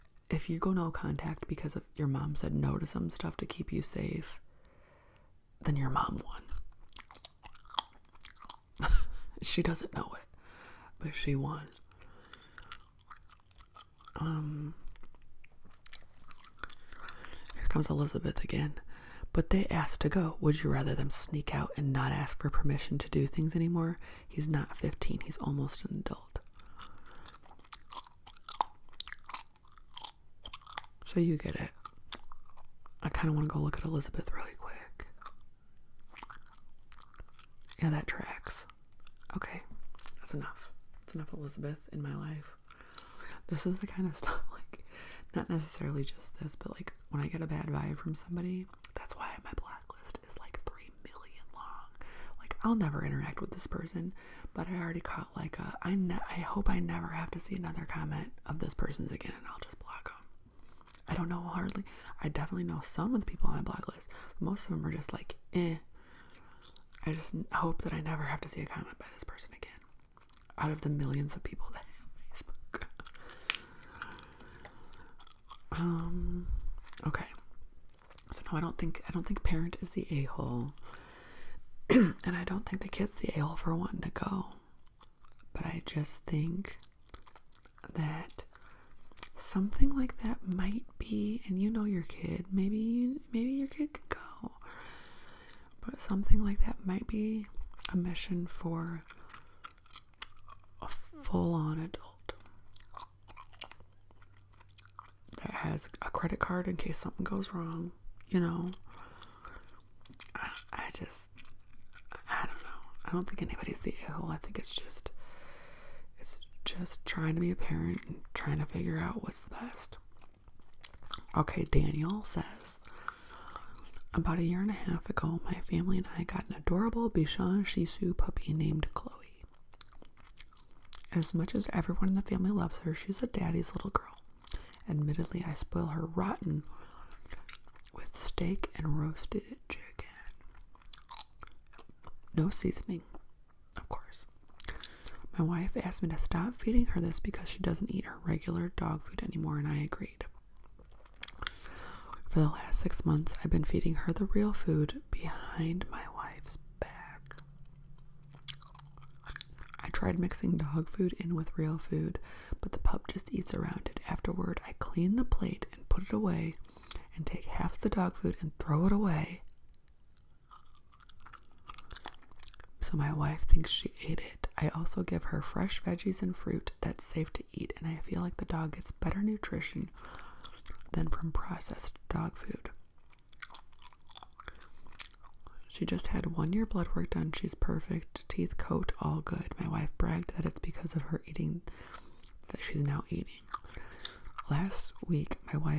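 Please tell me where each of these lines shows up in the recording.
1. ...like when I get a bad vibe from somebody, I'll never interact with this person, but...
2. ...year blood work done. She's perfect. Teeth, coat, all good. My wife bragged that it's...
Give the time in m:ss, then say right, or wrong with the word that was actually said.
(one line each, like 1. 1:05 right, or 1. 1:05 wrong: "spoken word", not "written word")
1. 0:46 right
2. 3:06 right.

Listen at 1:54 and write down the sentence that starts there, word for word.
I think it's just it's just trying to be a parent and trying to figure out what's the best.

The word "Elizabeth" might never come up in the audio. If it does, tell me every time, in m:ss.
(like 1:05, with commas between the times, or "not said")
0:17, 0:33, 0:41.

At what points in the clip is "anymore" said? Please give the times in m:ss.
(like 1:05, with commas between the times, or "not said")
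0:23, 2:29.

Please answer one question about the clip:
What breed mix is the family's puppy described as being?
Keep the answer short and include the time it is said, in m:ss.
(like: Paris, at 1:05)
Bichon Shih Tzu, at 2:07.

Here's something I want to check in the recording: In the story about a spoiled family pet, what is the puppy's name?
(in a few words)
Chloe.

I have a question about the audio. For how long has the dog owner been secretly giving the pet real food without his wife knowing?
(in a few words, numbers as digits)
6 months.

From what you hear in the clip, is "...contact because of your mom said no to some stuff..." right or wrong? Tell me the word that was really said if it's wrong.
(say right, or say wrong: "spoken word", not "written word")
right.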